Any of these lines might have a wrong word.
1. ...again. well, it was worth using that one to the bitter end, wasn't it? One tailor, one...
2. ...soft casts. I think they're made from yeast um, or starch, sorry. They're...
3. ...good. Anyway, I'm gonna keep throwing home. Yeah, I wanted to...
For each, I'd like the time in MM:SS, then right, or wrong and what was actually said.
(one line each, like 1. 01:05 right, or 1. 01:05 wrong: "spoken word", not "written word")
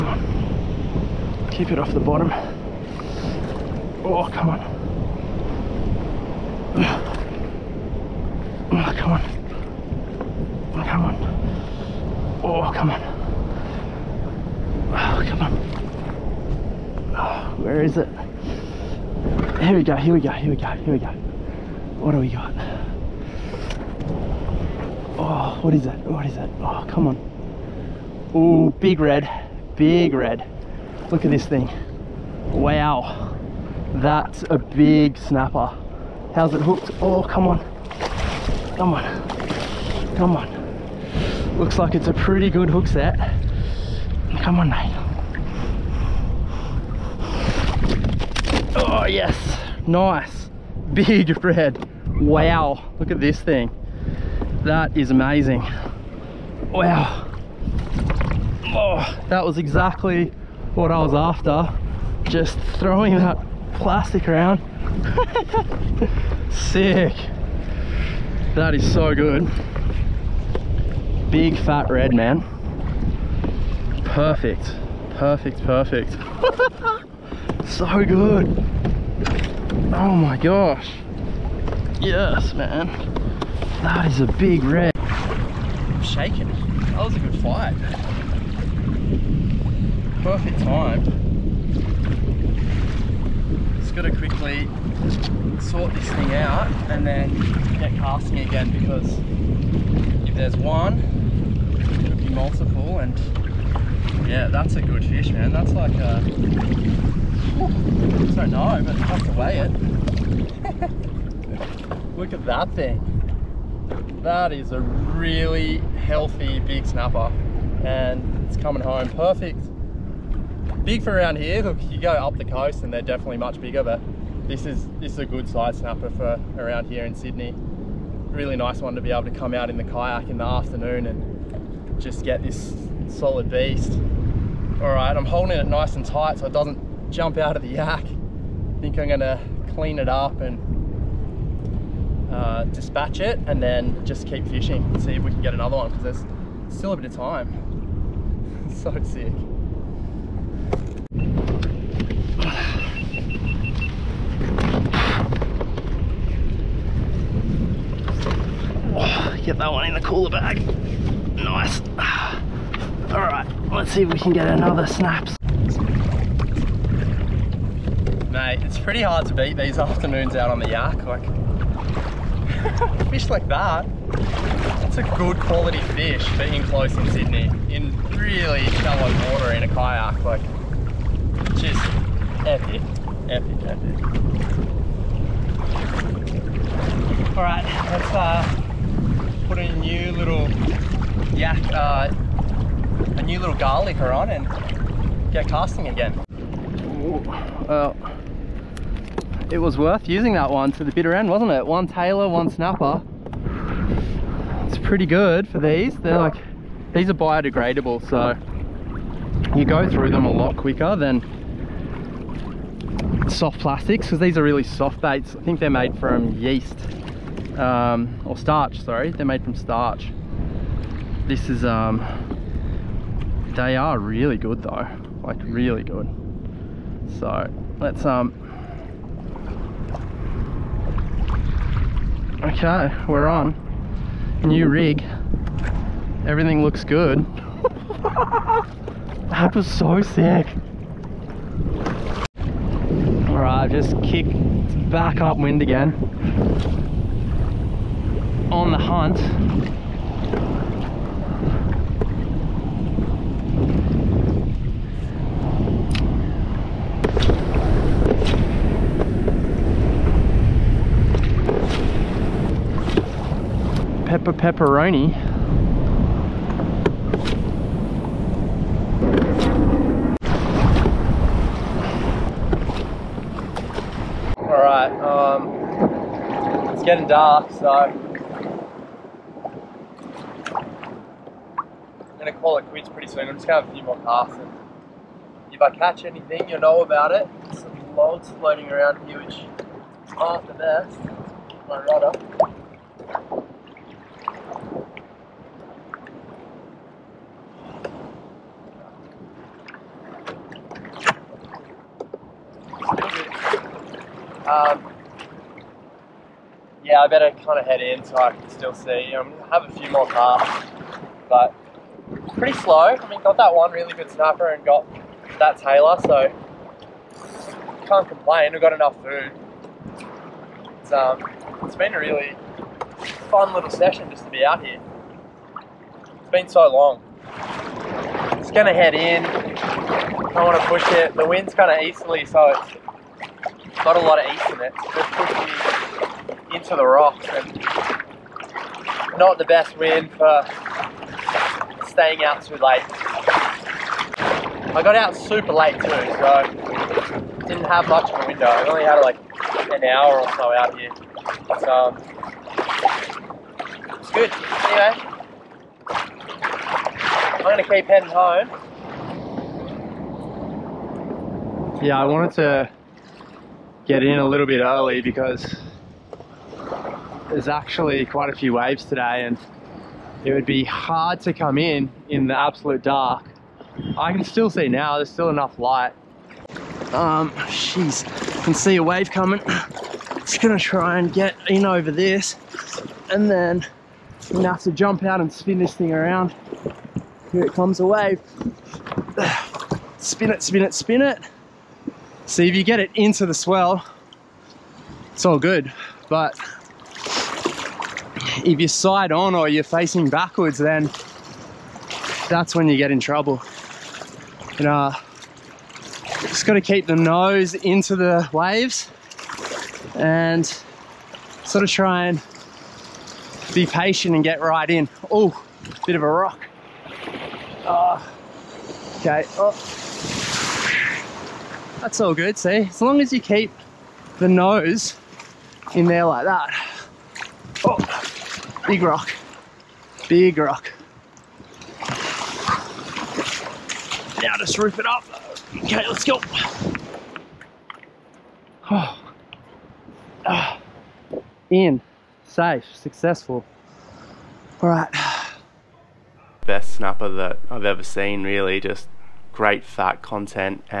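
1. 03:15 right
2. 03:34 wrong: "baits", not "casts"
3. 05:54 wrong: "heading", not "throwing".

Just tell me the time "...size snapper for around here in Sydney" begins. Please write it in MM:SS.
02:05.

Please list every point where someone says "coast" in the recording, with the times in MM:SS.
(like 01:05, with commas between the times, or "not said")
02:02.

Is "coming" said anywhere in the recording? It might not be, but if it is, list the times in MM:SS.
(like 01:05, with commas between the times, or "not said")
01:58, 06:19.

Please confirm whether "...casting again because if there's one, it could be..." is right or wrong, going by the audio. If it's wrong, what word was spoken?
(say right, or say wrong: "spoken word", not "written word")
right.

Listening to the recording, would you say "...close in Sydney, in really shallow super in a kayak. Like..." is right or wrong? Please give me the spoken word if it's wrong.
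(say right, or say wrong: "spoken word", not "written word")
wrong: "water", not "super".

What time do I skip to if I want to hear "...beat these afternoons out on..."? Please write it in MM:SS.
02:49.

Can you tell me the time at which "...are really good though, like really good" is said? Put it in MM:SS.
03:43.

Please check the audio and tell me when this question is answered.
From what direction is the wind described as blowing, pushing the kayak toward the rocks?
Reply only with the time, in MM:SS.
05:31.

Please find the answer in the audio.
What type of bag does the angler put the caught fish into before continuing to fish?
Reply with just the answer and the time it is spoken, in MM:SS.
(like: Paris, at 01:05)
cooler bag, at 02:40.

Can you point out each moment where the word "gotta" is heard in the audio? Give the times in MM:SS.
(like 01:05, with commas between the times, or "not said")
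01:33, 06:46.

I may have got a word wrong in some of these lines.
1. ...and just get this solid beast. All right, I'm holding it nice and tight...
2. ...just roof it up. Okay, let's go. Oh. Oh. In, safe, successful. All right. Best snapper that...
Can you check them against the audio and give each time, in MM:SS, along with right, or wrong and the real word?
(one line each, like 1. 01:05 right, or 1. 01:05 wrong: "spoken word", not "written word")
1. 02:11 right
2. 07:14 right.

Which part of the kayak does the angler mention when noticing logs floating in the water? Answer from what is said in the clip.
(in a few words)
rudder.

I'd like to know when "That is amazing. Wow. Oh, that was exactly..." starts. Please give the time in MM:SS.
00:54.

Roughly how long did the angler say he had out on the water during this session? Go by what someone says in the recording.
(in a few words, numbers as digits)
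an hour.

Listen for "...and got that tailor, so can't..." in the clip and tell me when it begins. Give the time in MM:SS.
05:14.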